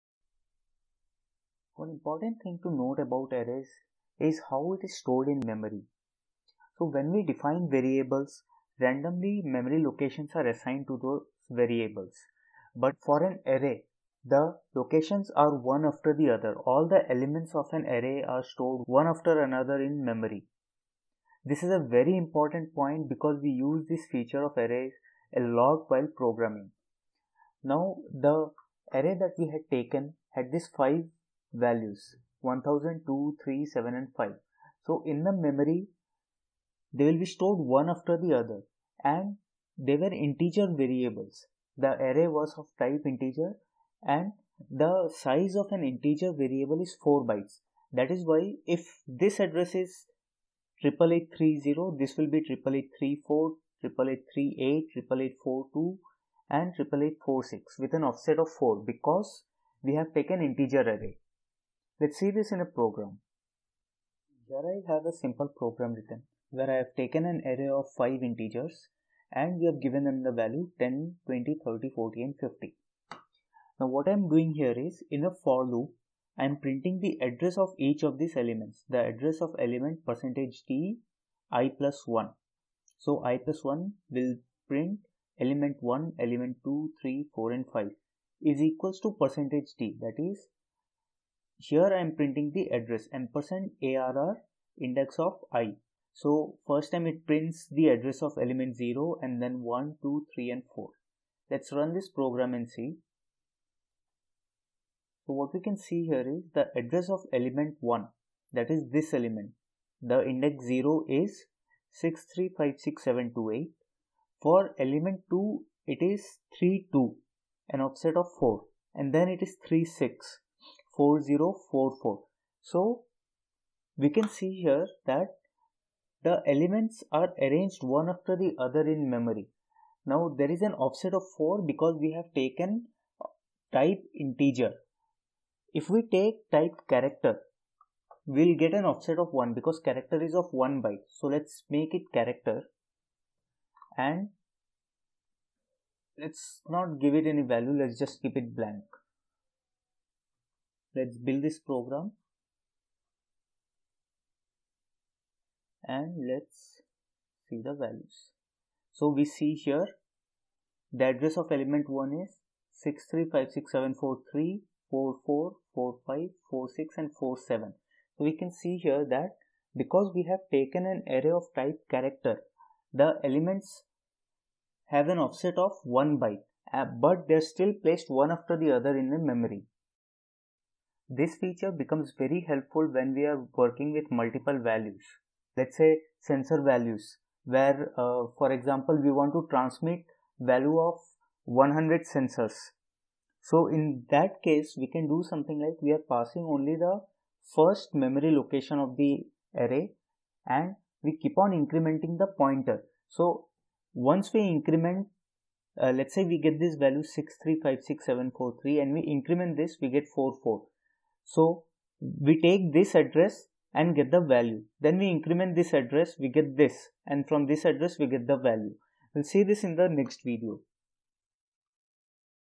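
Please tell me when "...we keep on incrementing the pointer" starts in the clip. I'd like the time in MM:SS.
03:21.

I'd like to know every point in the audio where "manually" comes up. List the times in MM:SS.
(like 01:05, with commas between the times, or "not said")
not said.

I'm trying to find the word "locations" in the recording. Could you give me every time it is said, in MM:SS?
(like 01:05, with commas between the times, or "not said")
00:09, 00:14, 03:18.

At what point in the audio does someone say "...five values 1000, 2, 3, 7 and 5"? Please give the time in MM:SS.
00:30.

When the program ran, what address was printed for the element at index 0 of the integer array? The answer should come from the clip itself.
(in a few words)
6356728.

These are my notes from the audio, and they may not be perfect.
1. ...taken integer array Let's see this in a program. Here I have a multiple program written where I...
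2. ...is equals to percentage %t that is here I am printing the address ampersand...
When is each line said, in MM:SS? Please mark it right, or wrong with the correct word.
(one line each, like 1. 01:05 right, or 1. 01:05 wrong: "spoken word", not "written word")
1. 01:00 wrong: "simple", not "multiple"
2. 01:28 right.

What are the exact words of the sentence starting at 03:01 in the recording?
This feature becomes very helpful when we are working with multiple values.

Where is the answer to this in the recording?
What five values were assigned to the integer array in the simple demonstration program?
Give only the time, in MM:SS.
01:10.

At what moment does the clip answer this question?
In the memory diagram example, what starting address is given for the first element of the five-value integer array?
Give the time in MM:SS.
00:50.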